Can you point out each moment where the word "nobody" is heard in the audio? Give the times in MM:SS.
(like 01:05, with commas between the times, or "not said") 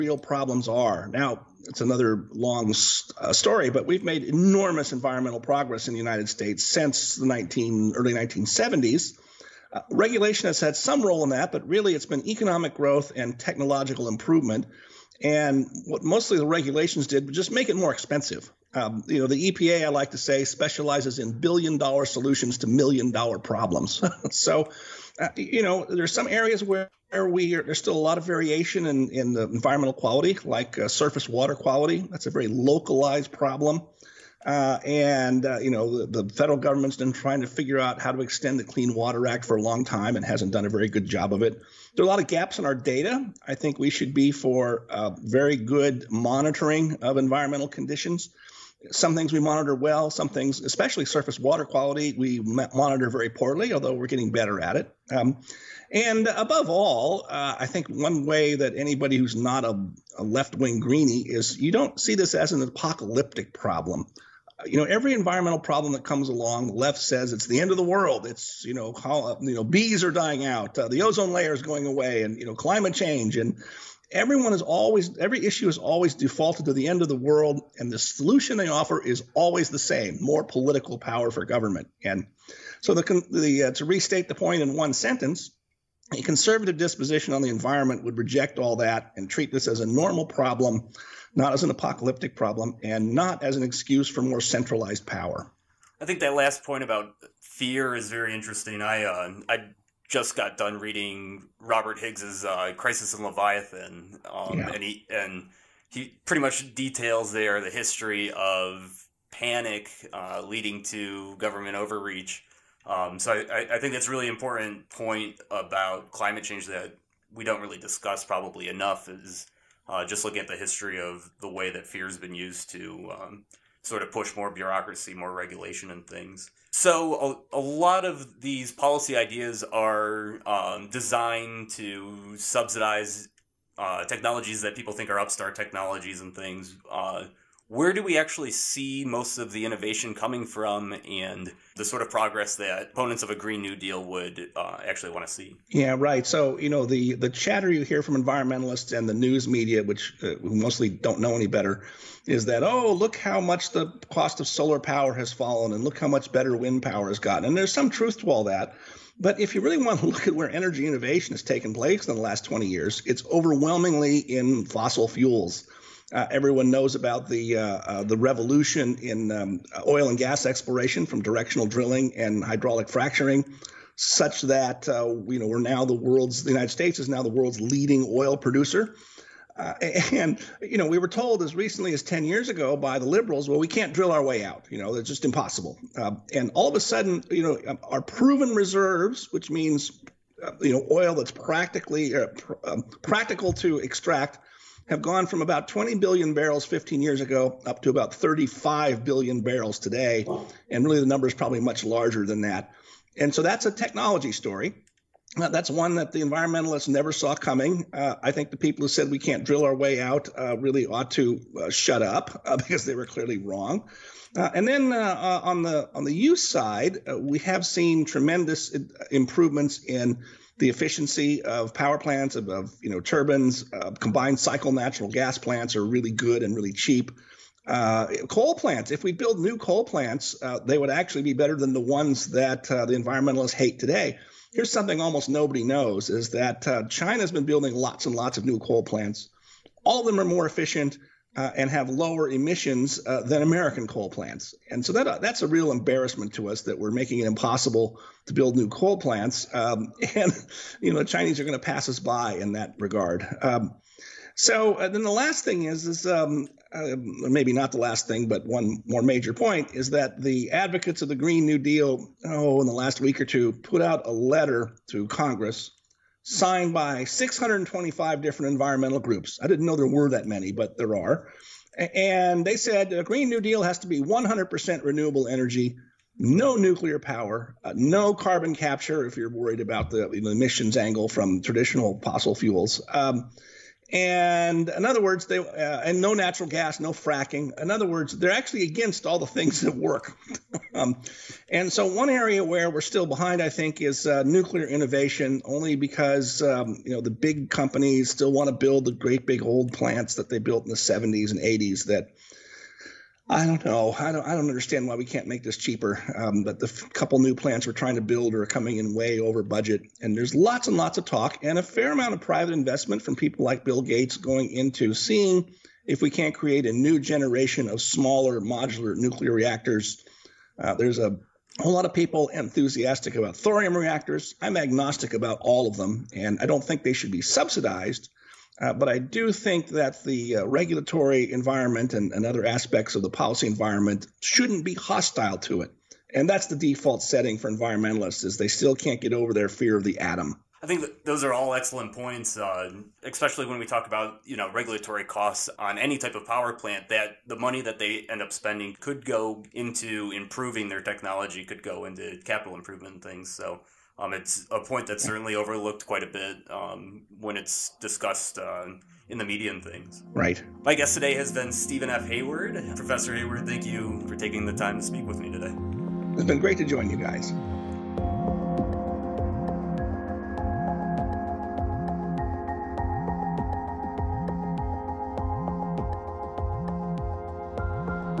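03:55.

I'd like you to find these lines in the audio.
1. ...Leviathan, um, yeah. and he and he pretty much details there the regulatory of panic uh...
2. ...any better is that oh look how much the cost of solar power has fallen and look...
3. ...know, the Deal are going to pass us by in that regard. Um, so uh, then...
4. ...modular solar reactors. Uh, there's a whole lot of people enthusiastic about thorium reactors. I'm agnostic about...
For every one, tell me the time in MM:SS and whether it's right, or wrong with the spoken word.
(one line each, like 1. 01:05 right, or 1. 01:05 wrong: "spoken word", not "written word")
1. 01:43 wrong: "history", not "regulatory"
2. 02:31 right
3. 04:10 wrong: "Chinese", not "Deal"
4. 05:18 wrong: "nuclear", not "solar".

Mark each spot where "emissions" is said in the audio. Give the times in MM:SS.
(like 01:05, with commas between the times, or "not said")
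04:02, 04:40.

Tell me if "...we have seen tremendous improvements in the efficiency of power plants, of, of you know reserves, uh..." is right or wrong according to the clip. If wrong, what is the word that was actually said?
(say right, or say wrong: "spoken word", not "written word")
wrong: "turbines", not "reserves".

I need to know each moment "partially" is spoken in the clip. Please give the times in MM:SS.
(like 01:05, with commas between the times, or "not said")
not said.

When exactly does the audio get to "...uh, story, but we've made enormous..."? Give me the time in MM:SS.
00:03.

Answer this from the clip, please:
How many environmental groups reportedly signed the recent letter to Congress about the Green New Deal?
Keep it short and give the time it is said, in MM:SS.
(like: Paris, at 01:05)
625, at 04:27.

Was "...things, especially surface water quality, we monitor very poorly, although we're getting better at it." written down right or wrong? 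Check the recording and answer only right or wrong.
right.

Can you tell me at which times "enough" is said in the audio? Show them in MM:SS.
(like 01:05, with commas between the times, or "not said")
01:58.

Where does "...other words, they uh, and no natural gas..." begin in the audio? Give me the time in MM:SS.
04:44.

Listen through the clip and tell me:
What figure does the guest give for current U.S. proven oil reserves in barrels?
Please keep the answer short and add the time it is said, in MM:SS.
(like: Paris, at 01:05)
35 billion barrels, at 03:18.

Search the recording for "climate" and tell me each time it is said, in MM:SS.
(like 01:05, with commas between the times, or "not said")
01:12, 01:56.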